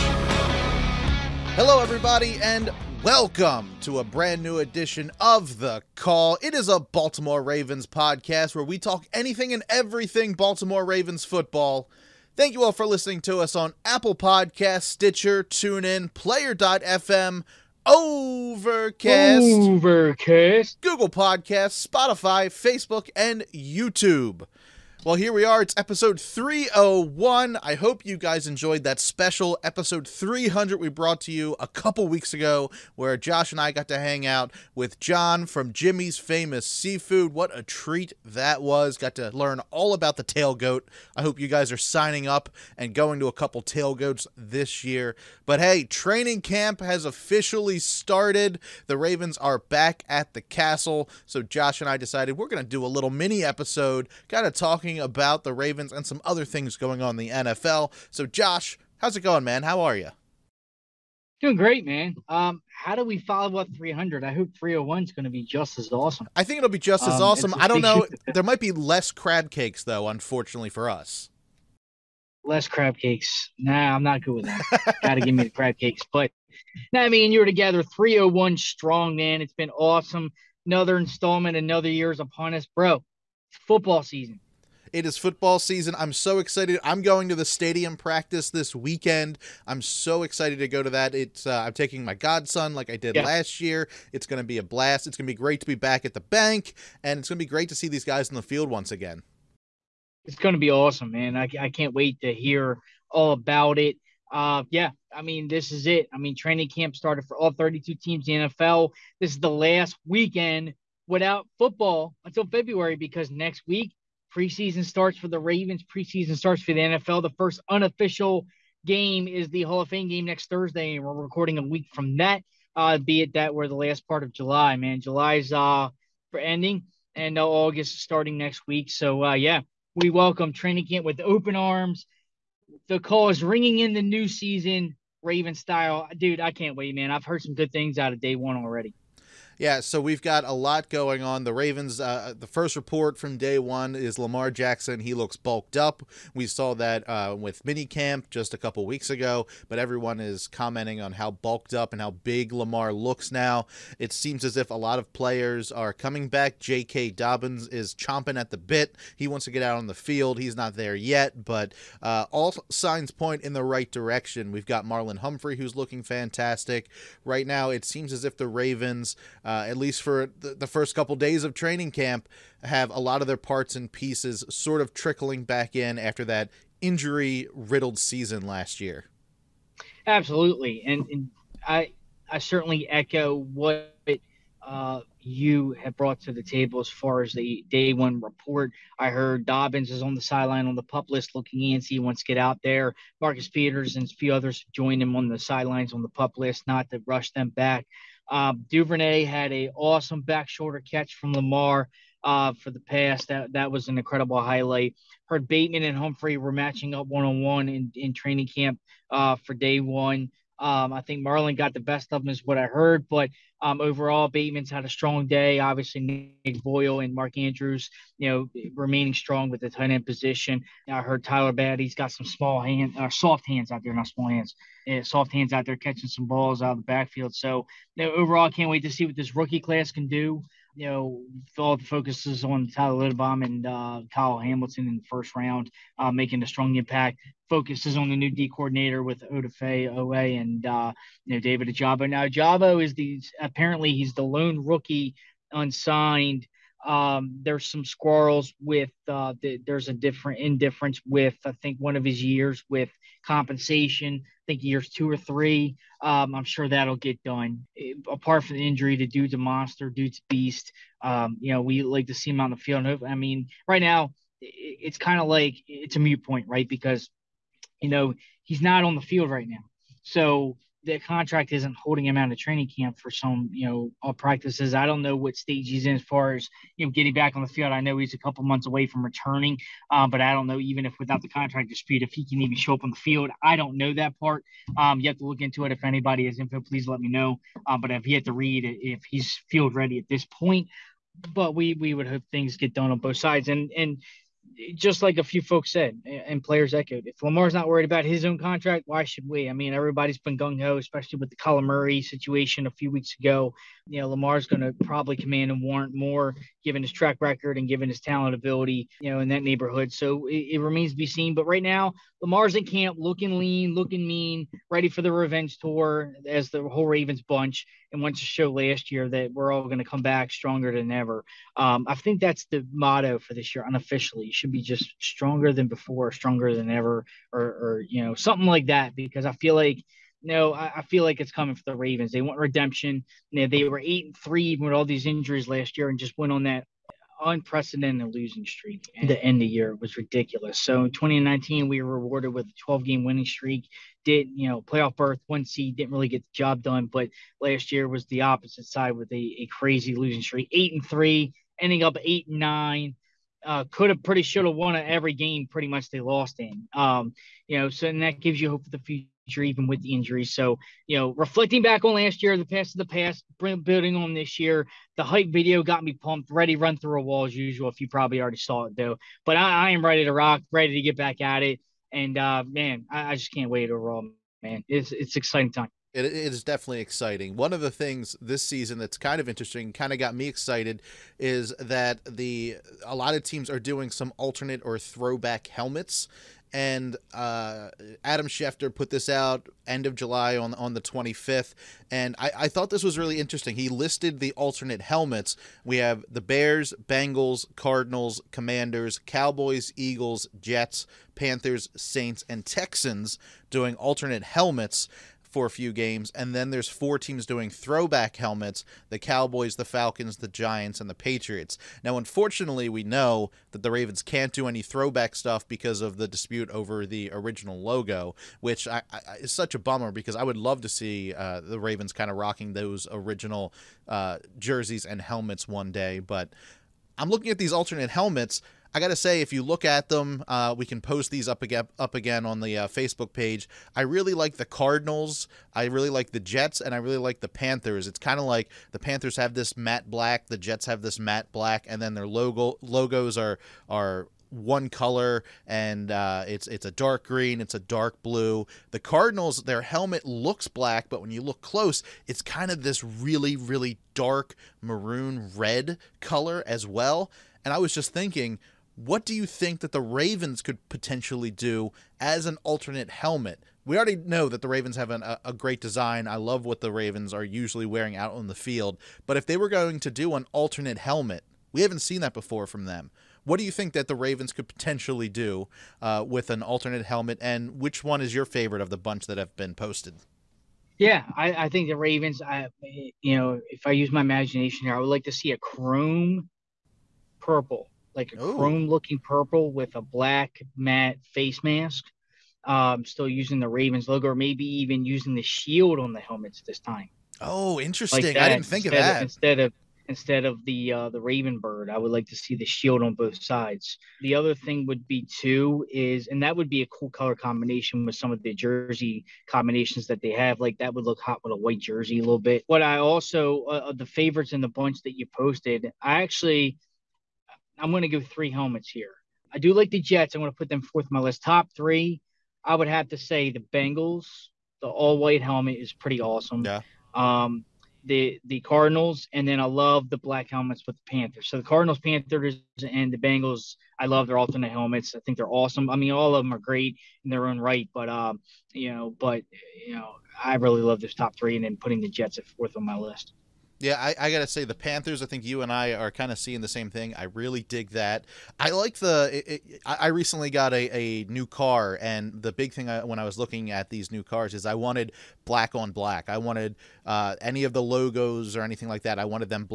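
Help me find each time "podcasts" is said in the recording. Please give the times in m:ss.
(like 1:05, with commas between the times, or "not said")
0:07, 0:14, 0:21.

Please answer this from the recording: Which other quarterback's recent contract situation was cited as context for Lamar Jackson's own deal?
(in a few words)
Kyler Murray.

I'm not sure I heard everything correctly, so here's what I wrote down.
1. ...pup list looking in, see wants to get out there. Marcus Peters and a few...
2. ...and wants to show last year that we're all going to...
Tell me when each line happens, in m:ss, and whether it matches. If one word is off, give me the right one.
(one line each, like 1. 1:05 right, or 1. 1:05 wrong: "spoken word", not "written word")
1. 3:10 right
2. 5:17 right.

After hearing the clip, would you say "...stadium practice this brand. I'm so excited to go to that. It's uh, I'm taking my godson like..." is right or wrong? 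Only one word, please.
wrong.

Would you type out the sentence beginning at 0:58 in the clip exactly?
So, Josh, how's it going, man?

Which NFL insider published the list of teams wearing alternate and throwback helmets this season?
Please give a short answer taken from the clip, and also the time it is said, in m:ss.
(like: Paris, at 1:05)
Adam Schefter, at 6:28.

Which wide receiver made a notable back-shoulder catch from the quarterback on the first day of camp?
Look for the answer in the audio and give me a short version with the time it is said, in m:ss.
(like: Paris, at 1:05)
Duvernay, at 3:18.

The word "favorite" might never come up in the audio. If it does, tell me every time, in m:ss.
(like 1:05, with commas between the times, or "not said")
7:58, 8:33.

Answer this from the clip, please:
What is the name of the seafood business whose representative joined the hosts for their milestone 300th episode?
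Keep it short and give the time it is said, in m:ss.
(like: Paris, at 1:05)
Jimmy's Famous Seafood, at 0:35.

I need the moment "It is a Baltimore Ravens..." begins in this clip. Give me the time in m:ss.
0:06.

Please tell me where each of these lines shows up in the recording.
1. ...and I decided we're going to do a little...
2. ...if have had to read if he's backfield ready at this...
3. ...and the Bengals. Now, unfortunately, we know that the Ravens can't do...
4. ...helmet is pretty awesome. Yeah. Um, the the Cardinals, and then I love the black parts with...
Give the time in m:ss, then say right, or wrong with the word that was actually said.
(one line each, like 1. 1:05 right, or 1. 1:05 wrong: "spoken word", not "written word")
1. 0:51 right
2. 4:47 wrong: "field", not "backfield"
3. 6:50 wrong: "Patriots", not "Bengals"
4. 8:45 wrong: "helmets", not "parts".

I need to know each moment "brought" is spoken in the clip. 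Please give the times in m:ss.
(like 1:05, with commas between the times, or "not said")
0:30, 3:05.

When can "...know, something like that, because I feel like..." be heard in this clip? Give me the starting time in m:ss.
5:28.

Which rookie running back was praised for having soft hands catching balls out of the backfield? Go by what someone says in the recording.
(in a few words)
Tyler Badie.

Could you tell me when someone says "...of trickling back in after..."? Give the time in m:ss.
2:54.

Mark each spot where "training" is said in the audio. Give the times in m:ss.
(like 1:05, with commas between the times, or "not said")
0:45, 1:46, 2:10, 2:51, 3:28, 4:32.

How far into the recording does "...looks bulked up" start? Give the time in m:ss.
2:25.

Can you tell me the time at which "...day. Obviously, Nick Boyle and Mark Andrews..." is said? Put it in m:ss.
3:35.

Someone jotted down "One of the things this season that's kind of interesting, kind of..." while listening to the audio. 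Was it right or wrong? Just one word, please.
right.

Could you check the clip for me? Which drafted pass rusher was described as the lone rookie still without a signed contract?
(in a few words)
David Ojabo.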